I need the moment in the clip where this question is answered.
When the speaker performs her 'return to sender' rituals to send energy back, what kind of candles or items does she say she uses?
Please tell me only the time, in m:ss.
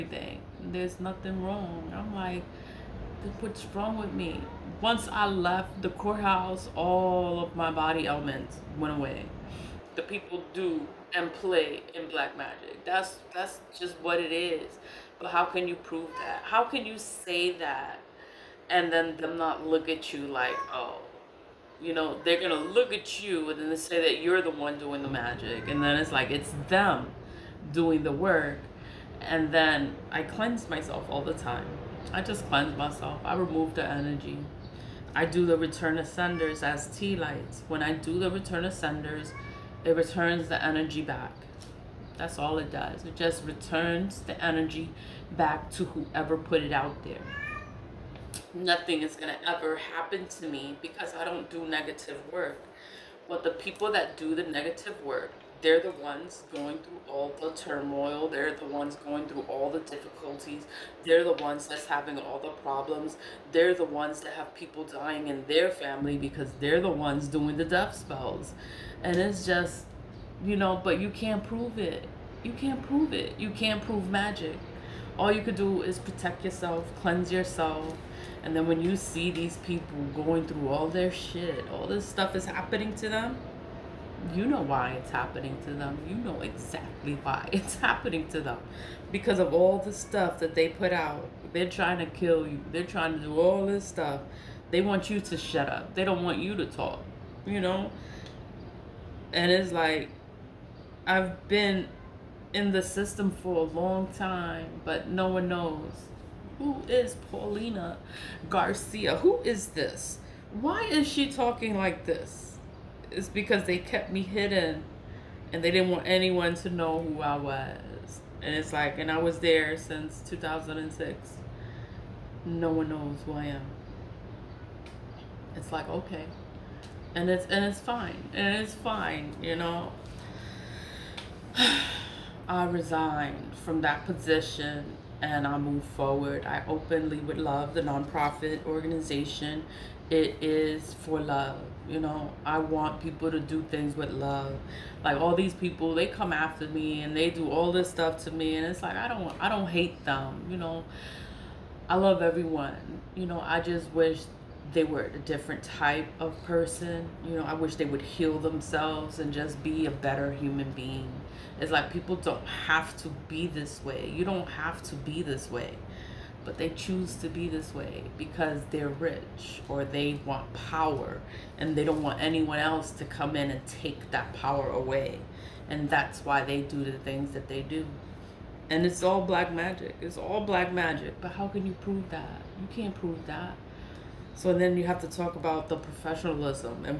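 0:36.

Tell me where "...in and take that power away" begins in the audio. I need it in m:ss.
2:53.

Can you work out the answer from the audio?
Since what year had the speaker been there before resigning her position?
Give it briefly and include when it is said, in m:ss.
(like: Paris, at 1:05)
2006, at 2:00.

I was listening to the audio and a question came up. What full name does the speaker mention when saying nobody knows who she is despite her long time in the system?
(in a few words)
Paulina Garcia.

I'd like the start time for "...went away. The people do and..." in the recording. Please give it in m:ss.
0:08.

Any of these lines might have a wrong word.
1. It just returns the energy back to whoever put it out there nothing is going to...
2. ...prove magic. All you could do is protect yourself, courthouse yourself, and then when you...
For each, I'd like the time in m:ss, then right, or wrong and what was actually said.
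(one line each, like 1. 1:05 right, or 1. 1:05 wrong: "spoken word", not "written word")
1. 0:43 right
2. 1:13 wrong: "cleanse", not "courthouse".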